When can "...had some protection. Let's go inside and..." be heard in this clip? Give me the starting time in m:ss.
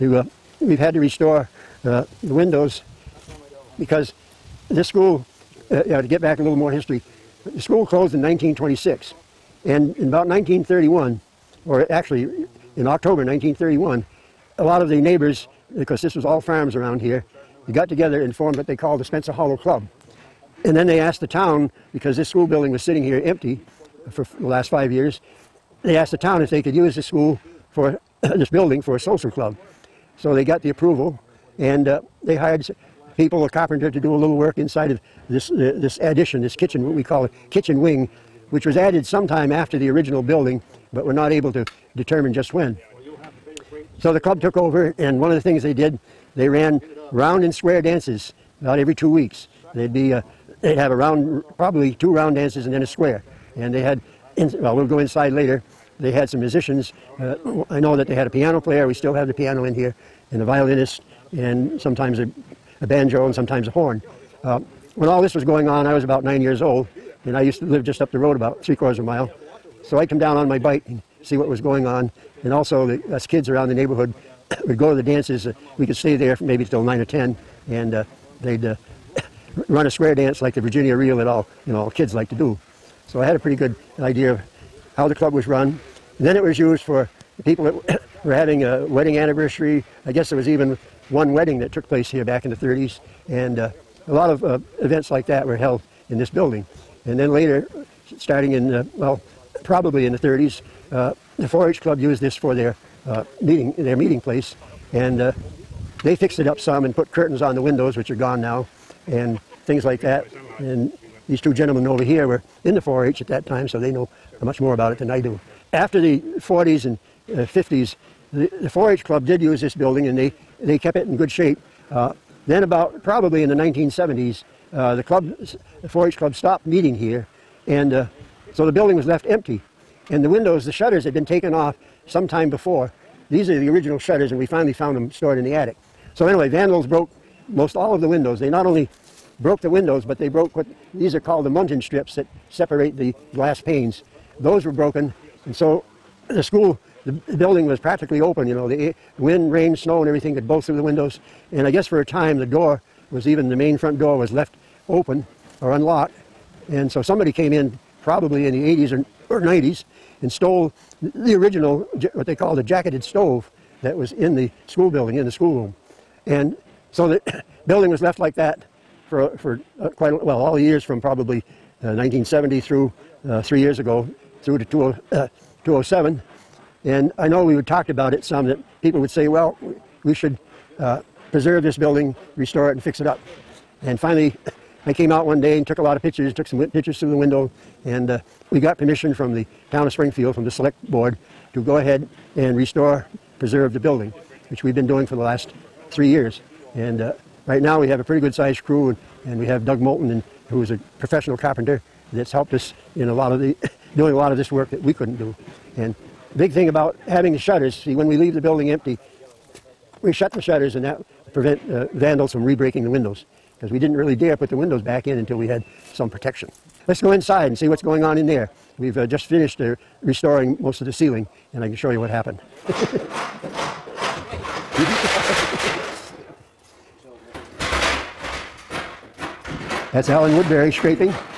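3:35.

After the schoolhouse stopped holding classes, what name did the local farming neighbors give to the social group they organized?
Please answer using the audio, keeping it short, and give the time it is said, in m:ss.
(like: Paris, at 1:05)
Spencer Hollow Club, at 0:19.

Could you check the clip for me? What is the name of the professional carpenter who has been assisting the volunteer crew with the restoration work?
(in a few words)
Doug Moulton.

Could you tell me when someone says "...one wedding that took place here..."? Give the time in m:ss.
1:31.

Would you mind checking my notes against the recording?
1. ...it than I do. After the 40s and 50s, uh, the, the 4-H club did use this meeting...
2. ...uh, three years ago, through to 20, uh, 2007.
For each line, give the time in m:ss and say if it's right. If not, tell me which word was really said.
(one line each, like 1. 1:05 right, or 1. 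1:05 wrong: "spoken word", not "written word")
1. 1:54 wrong: "building", not "meeting"
2. 2:53 right.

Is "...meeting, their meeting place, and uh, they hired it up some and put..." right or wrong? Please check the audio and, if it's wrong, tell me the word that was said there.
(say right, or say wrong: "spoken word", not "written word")
wrong: "fixed", not "hired".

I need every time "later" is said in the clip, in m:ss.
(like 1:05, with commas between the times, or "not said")
0:55, 1:37.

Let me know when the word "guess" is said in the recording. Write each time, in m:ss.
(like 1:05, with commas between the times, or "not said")
1:30, 2:31.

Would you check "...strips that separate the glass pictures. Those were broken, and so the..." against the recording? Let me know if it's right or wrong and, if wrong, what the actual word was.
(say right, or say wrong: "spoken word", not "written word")
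wrong: "panes", not "pictures".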